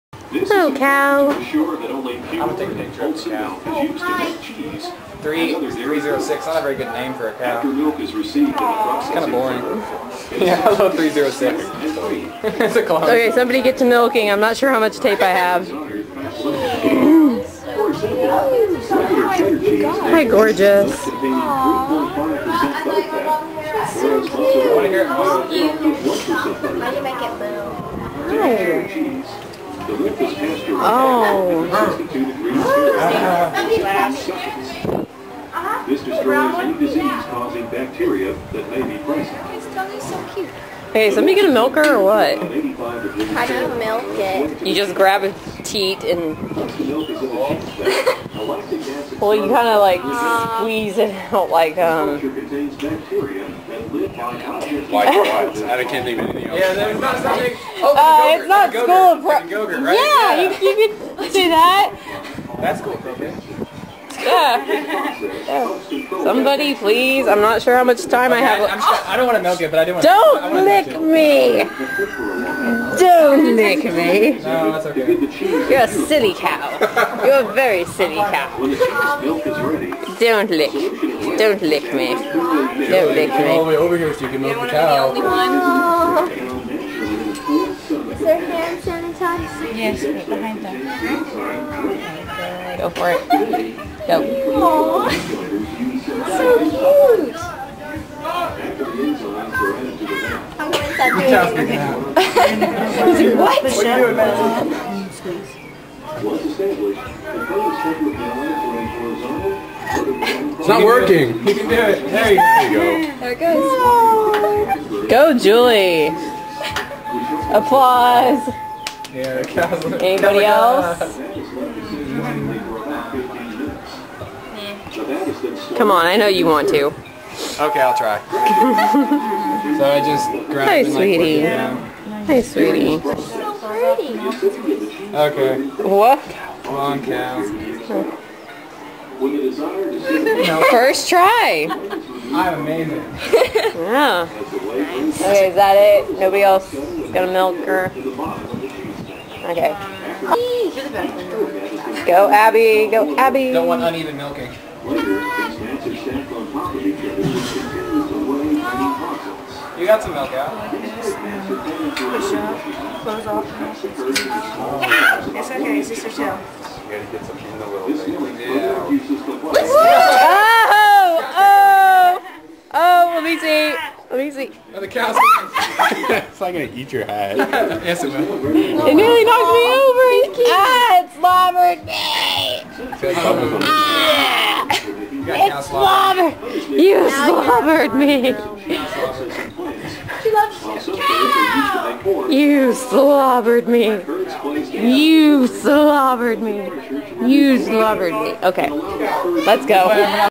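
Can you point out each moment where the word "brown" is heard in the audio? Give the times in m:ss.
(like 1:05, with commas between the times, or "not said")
not said.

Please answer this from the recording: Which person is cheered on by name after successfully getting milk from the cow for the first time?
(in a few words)
Julie.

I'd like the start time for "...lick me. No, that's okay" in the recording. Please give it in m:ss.
1:13.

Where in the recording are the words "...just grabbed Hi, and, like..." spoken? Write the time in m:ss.
2:10.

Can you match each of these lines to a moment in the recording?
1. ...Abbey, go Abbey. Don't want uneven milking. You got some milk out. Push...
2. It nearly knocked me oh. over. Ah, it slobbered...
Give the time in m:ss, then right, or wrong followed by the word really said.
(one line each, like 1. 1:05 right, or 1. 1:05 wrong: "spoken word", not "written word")
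1. 2:32 right
2. 2:58 right.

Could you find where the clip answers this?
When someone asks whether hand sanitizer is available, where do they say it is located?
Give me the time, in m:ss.
1:30.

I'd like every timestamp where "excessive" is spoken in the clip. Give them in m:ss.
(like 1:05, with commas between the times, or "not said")
not said.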